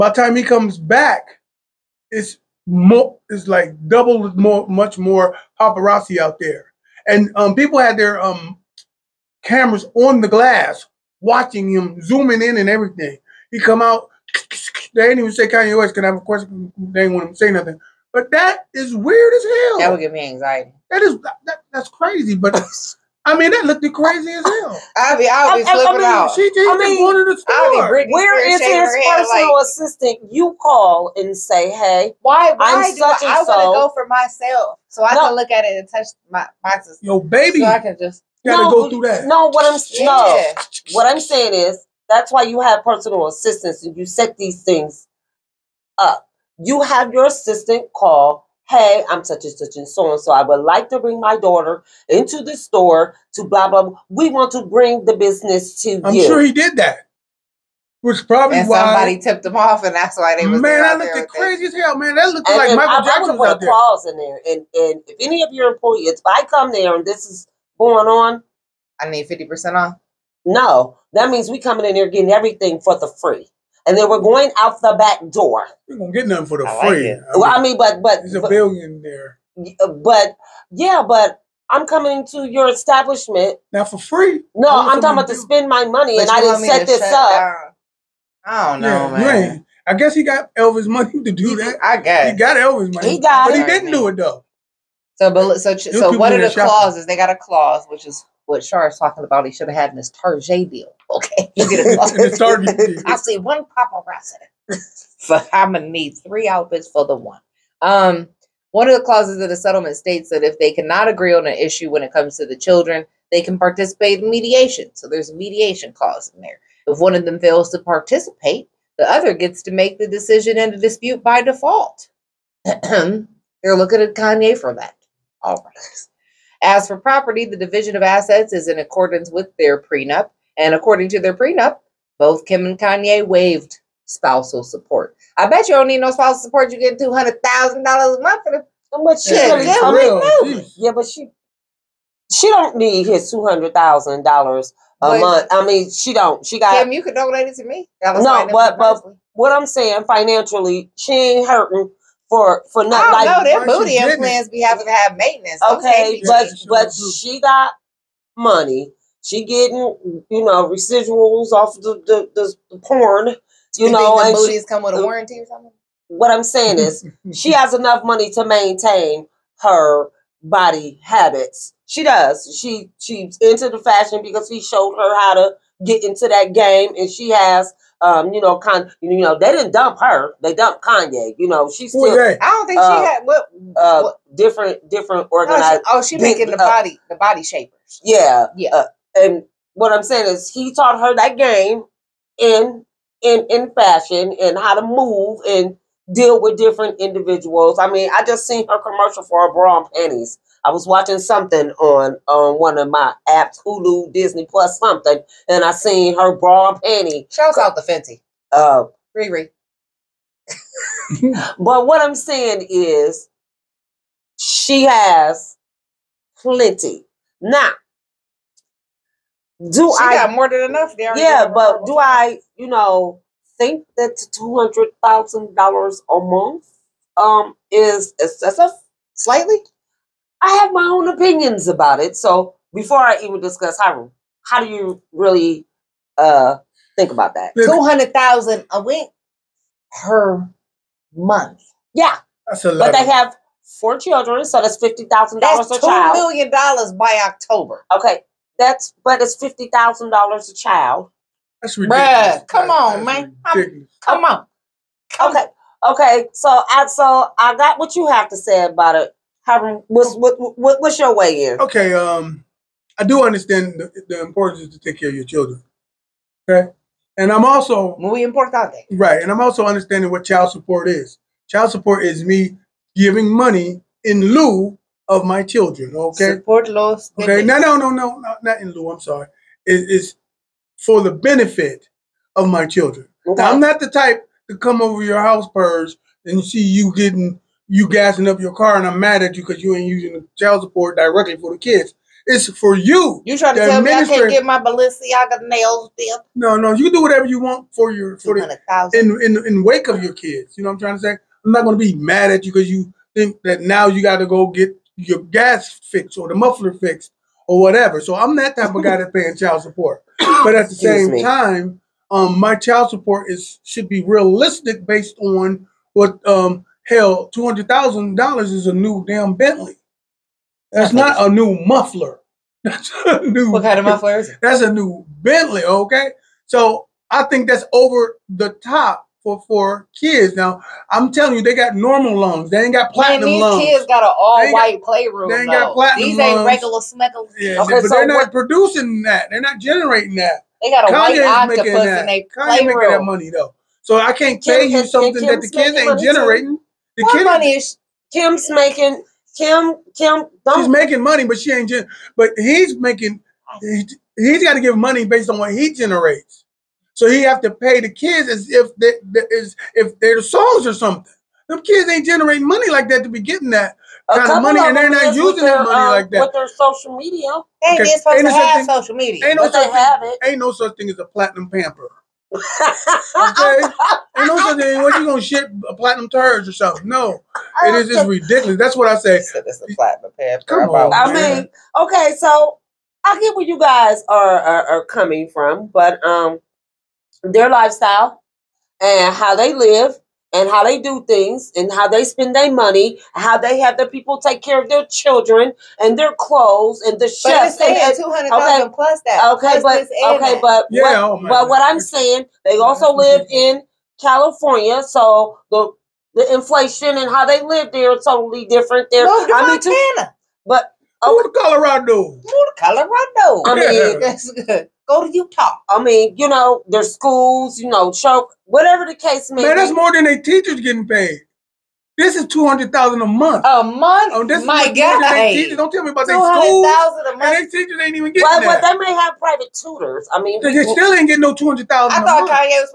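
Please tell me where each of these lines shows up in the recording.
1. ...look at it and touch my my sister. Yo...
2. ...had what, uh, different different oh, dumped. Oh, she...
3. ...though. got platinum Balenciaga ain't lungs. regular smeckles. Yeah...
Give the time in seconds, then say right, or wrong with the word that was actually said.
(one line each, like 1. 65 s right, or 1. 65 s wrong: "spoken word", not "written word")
1. 35 s right
2. 183 s wrong: "organized", not "dumped"
3. 335 s wrong: "These", not "Balenciaga".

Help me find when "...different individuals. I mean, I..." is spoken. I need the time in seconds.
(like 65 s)
196 s.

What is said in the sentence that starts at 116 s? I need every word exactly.
If one of them fails to participate, the other gets to make the decision in the dispute by default.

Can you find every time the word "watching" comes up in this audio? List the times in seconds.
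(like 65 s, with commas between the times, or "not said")
11 s, 200 s.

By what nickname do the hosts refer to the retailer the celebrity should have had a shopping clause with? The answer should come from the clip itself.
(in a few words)
Tarjay.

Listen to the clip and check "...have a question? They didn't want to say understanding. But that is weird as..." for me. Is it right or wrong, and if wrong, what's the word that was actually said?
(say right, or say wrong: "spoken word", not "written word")
wrong: "nothing", not "understanding".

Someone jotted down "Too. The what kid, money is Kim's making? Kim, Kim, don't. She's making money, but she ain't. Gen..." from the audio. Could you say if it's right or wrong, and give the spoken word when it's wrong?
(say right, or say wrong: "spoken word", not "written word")
right.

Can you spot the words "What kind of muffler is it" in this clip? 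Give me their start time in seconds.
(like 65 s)
323 s.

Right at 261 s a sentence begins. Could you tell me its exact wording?
Okay, um, I do understand the, the importance to take care of your children.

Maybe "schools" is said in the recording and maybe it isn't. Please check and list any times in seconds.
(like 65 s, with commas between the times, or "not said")
416 s, 426 s.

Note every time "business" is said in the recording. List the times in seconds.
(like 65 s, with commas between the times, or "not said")
55 s.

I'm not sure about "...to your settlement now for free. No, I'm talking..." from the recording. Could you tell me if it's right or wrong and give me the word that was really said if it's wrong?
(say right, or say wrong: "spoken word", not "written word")
wrong: "establishment", not "settlement".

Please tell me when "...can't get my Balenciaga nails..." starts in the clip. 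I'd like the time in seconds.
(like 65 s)
294 s.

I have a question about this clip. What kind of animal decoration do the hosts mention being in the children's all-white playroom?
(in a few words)
octopus.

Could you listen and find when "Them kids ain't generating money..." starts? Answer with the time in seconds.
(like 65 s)
361 s.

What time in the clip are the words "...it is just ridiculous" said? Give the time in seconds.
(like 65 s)
377 s.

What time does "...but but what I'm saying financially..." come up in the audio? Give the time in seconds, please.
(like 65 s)
148 s.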